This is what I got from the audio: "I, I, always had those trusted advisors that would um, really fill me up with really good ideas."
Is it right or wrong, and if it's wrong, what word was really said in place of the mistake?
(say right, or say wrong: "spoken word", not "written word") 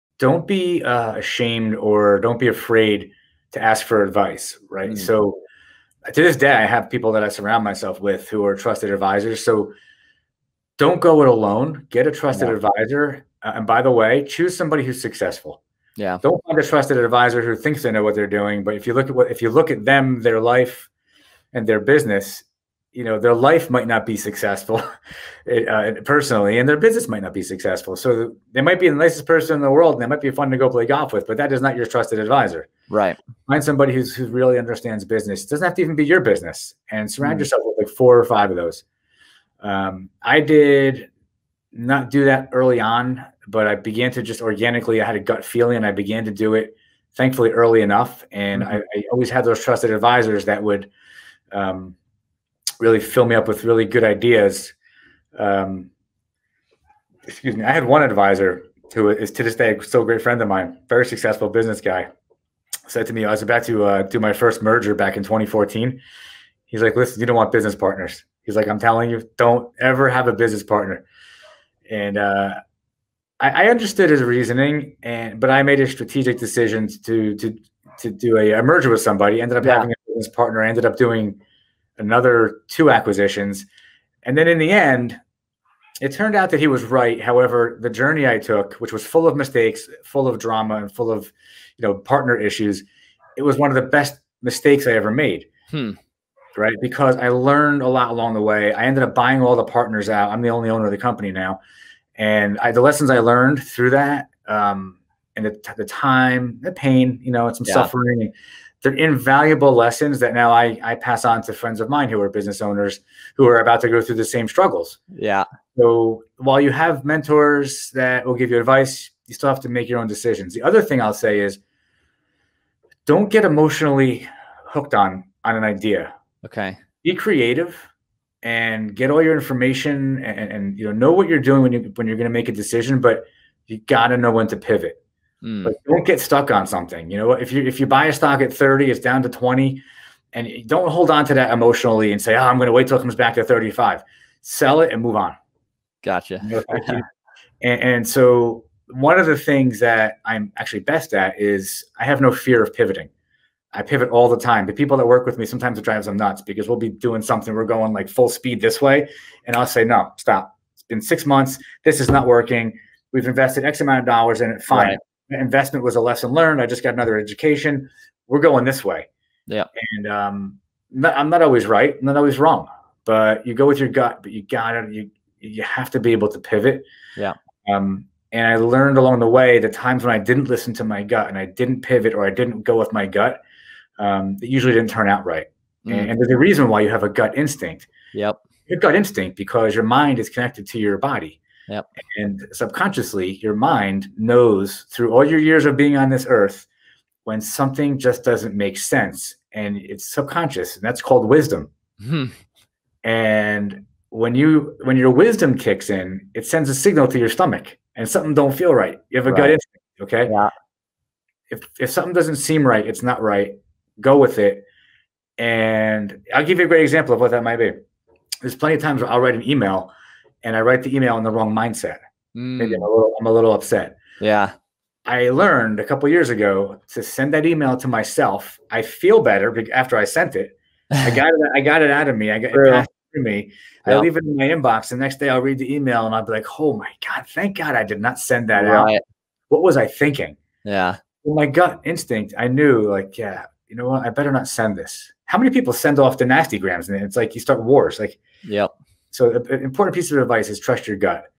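right.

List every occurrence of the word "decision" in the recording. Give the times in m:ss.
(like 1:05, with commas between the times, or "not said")
1:16, 2:00, 2:12.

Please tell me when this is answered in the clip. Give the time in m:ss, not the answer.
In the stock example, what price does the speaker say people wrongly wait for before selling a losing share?
2:23.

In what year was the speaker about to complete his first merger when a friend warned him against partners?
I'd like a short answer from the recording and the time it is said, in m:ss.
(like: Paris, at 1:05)
2014, at 1:05.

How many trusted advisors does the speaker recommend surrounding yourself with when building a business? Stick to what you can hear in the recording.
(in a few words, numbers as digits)
4 or 5.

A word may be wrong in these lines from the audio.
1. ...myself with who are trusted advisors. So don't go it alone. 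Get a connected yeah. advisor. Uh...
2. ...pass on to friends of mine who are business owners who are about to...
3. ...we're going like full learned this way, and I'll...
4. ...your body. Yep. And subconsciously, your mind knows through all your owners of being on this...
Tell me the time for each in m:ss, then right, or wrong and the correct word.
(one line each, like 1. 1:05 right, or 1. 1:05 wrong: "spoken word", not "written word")
1. 0:07 wrong: "trusted", not "connected"
2. 1:50 right
3. 2:37 wrong: "speed", not "learned"
4. 3:10 wrong: "years", not "owners".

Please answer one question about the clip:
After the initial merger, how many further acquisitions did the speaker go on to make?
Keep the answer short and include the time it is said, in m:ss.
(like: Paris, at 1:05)
2, at 1:22.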